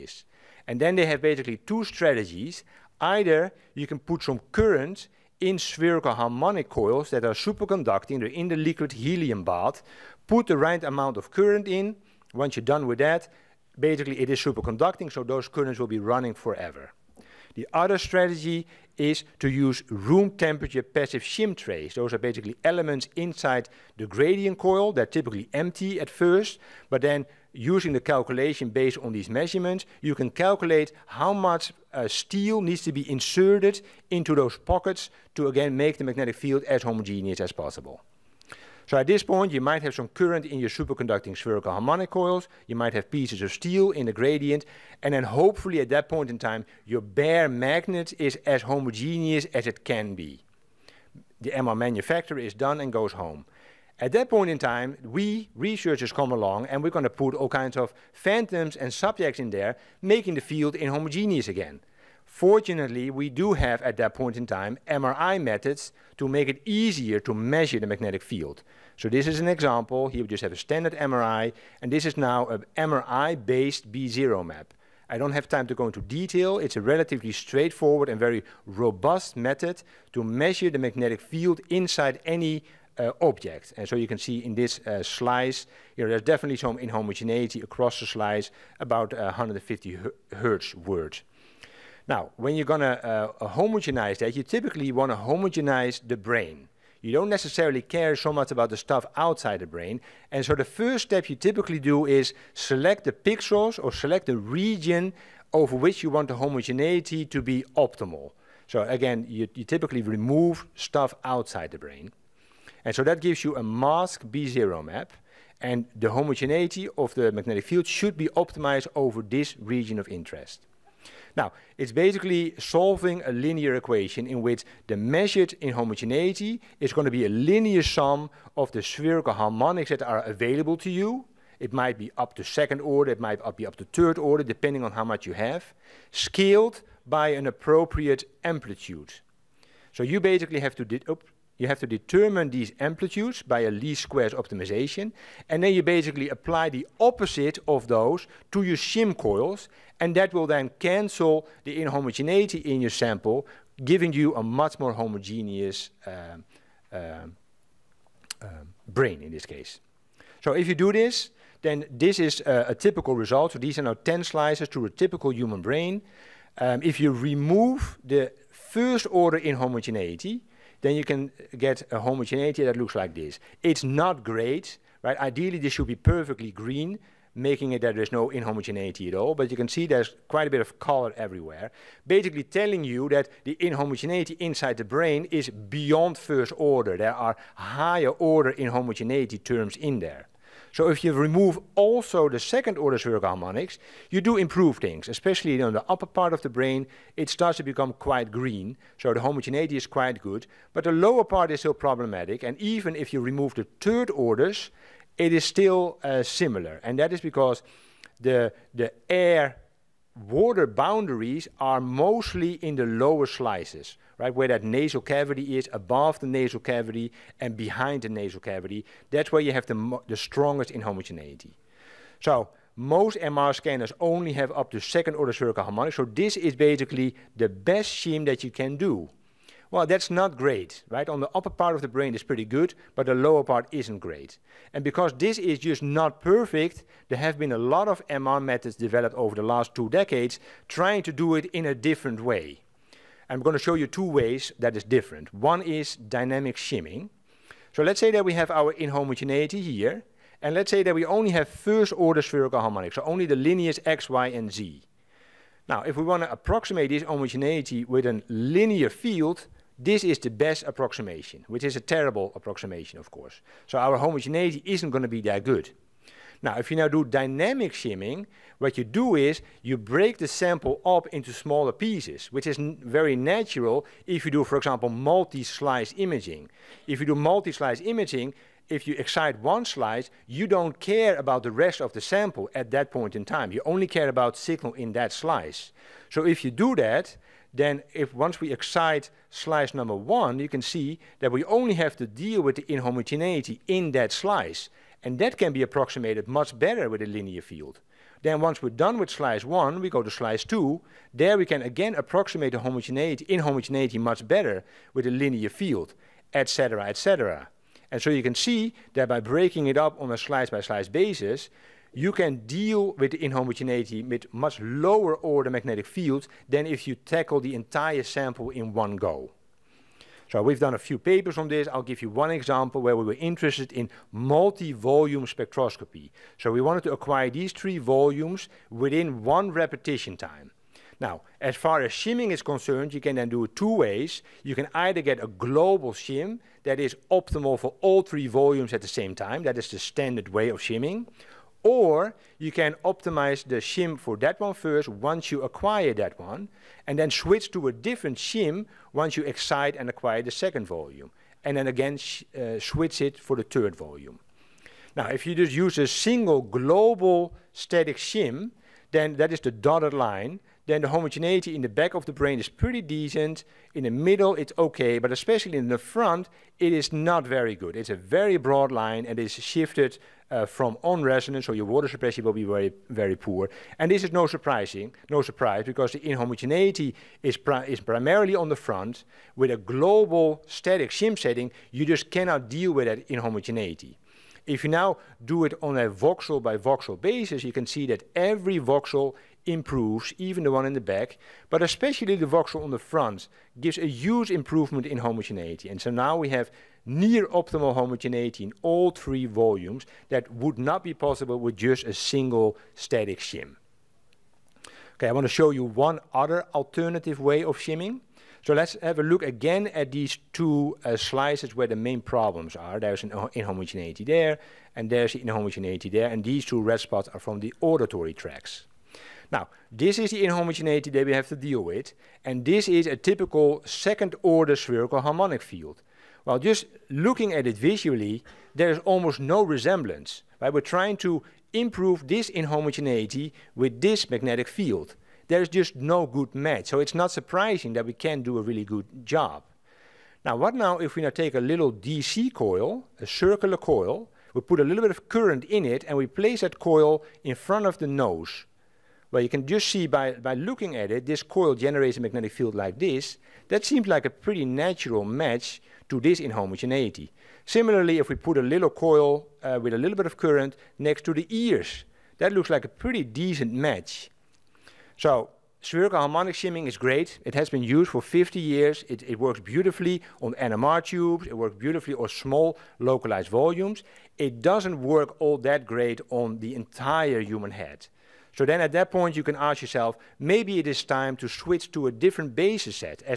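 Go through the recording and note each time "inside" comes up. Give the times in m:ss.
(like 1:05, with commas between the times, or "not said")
0:23, 1:21, 3:04.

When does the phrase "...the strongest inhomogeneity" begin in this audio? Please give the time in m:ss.
3:40.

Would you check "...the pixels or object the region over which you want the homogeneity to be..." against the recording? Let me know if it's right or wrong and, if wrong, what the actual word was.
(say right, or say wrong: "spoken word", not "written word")
wrong: "select", not "object".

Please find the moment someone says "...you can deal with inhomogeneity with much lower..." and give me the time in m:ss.
5:11.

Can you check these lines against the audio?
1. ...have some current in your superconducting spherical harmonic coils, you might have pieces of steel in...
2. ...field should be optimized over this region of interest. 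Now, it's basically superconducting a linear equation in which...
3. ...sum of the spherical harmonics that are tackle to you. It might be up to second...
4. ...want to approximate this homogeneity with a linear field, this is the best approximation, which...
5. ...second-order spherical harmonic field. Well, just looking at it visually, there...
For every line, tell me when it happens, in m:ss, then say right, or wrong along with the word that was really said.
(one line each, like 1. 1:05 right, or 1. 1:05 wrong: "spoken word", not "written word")
1. 0:39 right
2. 1:57 wrong: "solving", not "superconducting"
3. 2:07 wrong: "available", not "tackle"
4. 4:16 right
5. 7:03 right.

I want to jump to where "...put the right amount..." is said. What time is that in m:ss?
0:10.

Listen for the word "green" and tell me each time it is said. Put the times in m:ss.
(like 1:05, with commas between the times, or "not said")
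2:56, 3:18.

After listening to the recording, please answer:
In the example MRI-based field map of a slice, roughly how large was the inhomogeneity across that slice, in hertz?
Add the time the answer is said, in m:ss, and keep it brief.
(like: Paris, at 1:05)
150, at 1:29.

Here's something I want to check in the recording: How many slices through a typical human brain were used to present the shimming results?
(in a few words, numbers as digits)
10.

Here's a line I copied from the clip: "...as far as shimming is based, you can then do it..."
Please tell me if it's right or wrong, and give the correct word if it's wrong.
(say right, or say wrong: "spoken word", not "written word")
wrong: "concerned", not "based".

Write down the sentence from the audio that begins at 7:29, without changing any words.
Well, you can just see by, by looking at it, this coil generates a magnetic field like this.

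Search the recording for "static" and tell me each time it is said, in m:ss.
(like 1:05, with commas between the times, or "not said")
5:57, 6:20, 6:42.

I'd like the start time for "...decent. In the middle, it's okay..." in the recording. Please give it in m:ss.
6:02.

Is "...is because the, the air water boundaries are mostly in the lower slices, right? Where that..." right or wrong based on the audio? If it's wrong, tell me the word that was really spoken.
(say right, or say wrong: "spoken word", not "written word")
right.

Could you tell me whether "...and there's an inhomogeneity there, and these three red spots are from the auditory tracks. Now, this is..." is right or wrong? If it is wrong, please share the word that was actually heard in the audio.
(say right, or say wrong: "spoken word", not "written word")
wrong: "two", not "three".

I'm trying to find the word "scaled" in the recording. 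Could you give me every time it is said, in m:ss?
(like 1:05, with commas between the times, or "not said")
2:16.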